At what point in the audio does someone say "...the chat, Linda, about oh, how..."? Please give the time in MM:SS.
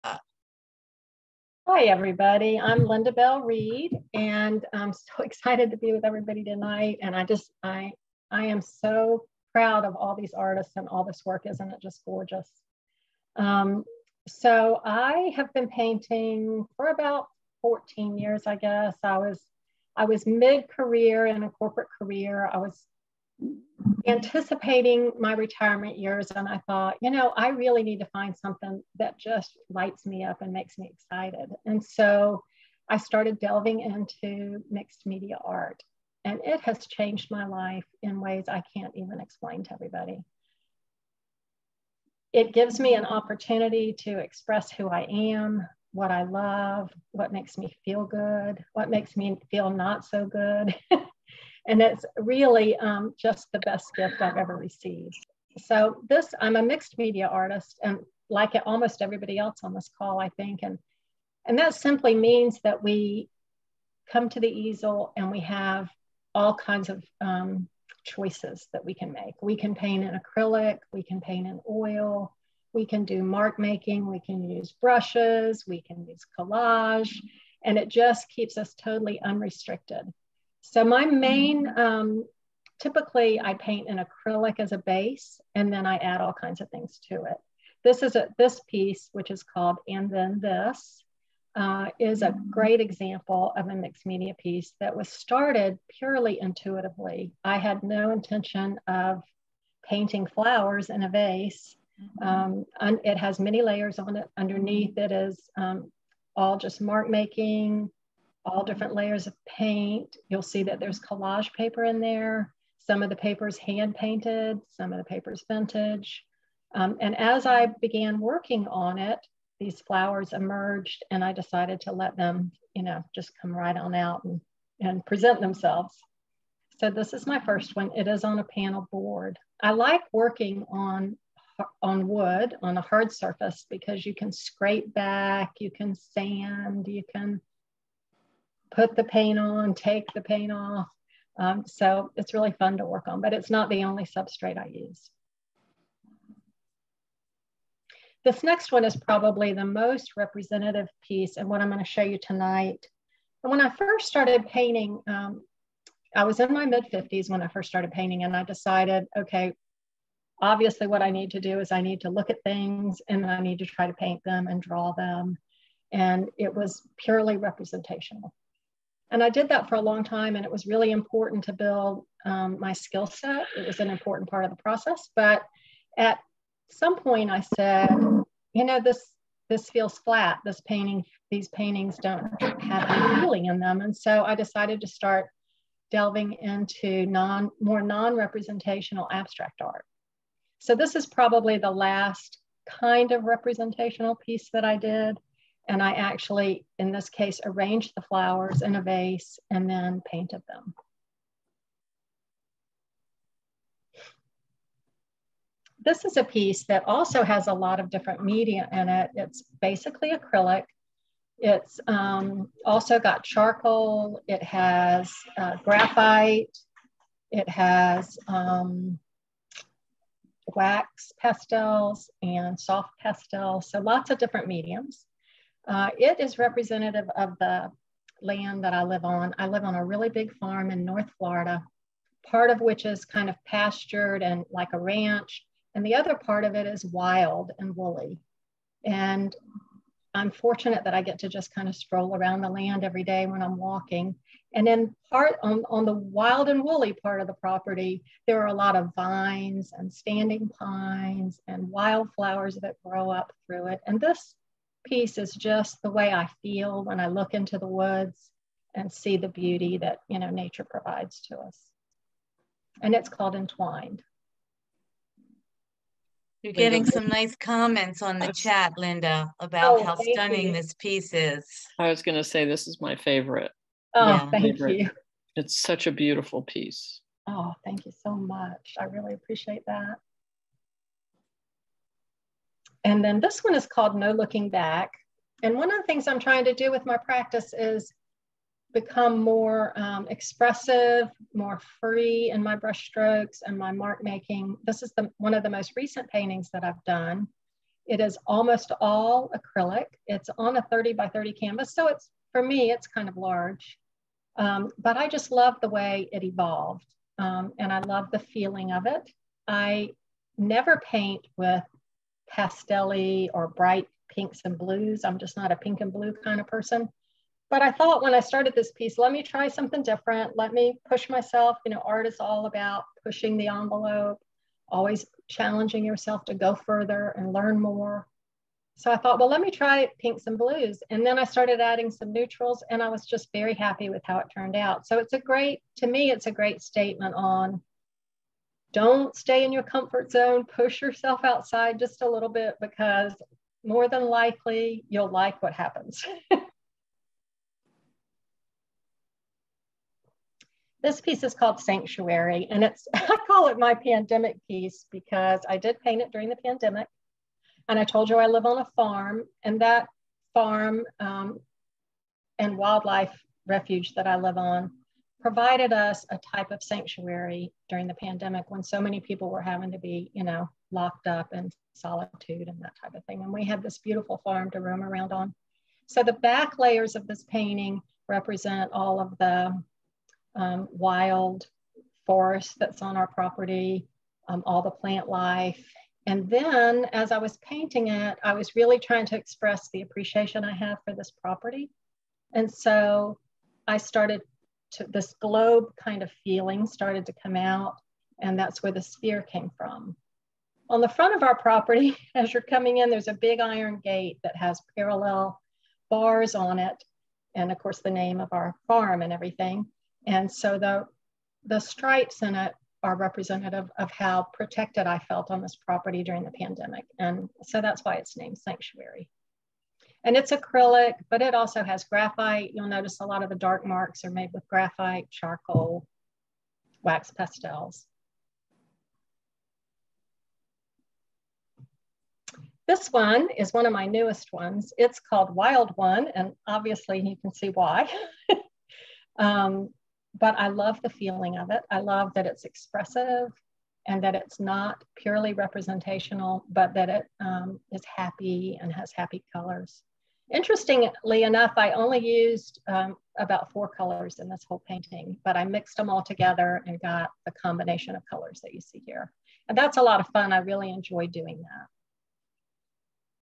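04:28.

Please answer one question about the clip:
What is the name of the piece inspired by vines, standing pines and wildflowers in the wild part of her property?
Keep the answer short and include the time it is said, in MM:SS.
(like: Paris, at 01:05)
Entwined, at 04:23.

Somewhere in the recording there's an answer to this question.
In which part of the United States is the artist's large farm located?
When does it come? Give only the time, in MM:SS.
03:50.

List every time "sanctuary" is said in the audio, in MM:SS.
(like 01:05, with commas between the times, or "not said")
05:51, 06:06, 06:58.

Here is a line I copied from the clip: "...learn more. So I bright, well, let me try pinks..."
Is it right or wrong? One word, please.
wrong.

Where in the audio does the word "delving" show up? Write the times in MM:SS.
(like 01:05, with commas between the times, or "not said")
00:33, 03:05.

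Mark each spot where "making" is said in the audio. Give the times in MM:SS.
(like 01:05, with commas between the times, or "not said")
01:13, 01:47, 04:54.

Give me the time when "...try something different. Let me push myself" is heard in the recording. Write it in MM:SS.
05:19.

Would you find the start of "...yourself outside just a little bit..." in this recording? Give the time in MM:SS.
05:40.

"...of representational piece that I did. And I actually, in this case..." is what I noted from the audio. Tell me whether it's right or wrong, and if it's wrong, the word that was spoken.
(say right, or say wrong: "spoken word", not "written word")
right.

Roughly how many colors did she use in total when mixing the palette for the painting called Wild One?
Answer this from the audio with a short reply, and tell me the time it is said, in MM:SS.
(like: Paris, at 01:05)
4, at 07:33.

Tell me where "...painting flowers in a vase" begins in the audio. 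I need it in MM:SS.
01:39.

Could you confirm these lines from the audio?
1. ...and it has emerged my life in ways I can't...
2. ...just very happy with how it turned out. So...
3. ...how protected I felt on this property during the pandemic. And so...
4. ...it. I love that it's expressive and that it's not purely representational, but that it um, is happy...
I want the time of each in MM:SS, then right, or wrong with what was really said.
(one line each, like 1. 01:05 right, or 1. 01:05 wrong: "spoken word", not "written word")
1. 00:36 wrong: "changed", not "emerged"
2. 05:33 right
3. 06:53 right
4. 07:21 right.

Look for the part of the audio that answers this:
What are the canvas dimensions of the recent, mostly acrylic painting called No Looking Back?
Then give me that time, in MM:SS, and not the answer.
05:00.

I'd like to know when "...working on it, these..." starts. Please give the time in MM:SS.
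01:58.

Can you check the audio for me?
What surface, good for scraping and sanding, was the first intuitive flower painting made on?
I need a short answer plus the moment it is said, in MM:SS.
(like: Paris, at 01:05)
panel board, at 02:08.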